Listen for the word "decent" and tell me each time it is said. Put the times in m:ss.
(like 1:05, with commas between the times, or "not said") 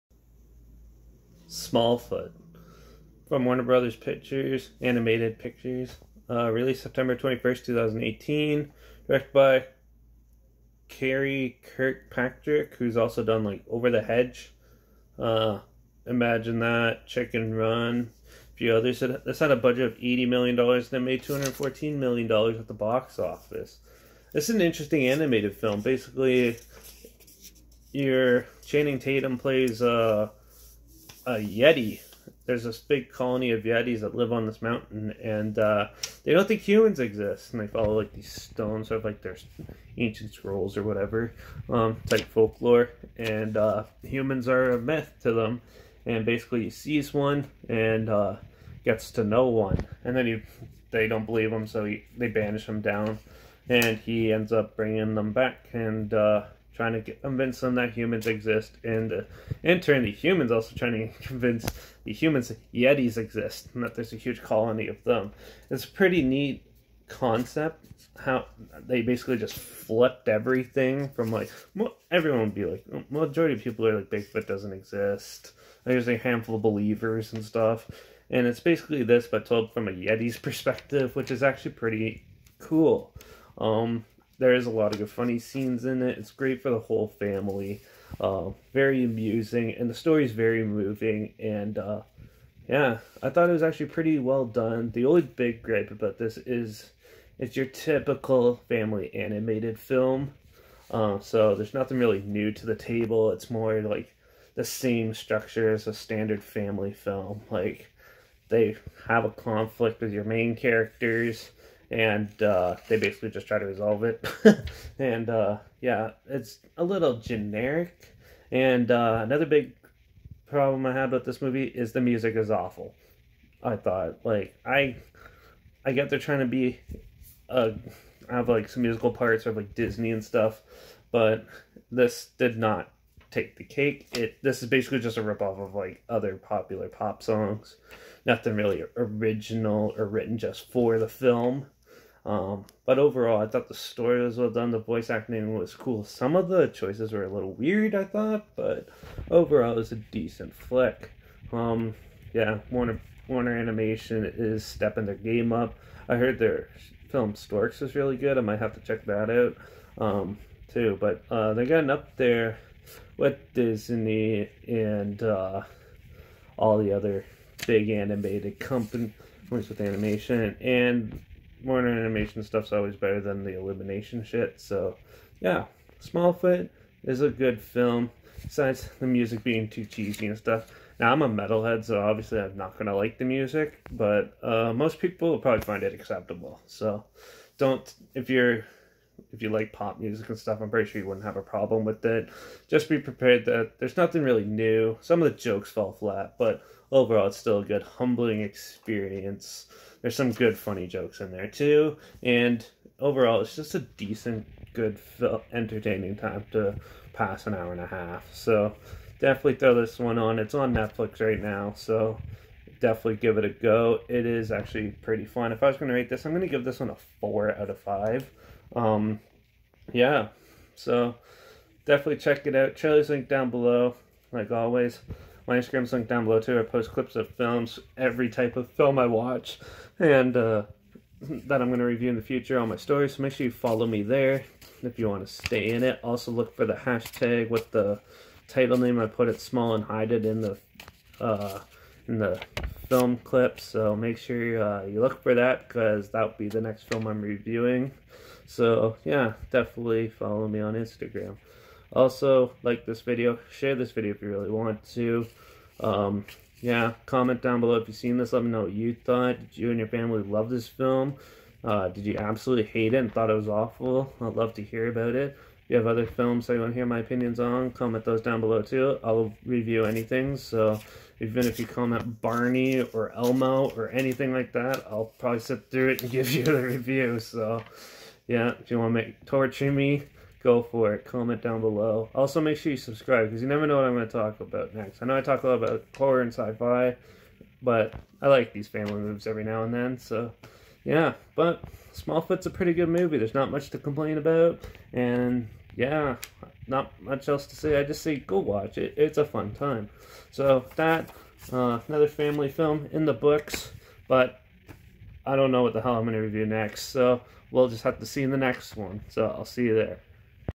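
2:29, 3:23.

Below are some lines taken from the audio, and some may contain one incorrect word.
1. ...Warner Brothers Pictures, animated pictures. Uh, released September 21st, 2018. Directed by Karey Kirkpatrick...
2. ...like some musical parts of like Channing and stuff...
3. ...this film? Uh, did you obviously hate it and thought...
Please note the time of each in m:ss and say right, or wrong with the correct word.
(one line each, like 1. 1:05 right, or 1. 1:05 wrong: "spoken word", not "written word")
1. 0:03 right
2. 2:08 wrong: "Disney", not "Channing"
3. 4:20 wrong: "absolutely", not "obviously".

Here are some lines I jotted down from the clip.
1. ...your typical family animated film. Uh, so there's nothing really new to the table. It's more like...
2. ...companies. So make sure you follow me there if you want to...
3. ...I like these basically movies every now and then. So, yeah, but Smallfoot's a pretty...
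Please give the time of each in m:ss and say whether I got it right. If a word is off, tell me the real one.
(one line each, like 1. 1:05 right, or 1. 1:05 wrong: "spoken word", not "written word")
1. 1:37 right
2. 3:52 wrong: "stories", not "companies"
3. 4:48 wrong: "family", not "basically".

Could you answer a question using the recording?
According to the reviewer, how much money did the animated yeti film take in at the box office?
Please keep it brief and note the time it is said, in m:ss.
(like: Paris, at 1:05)
$214 million, at 0:21.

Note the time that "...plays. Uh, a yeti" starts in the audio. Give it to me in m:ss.
0:29.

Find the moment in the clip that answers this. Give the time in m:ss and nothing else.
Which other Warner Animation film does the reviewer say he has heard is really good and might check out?
2:37.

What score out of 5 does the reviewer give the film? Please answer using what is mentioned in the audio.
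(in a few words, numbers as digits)
4.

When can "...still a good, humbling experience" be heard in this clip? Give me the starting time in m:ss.
3:17.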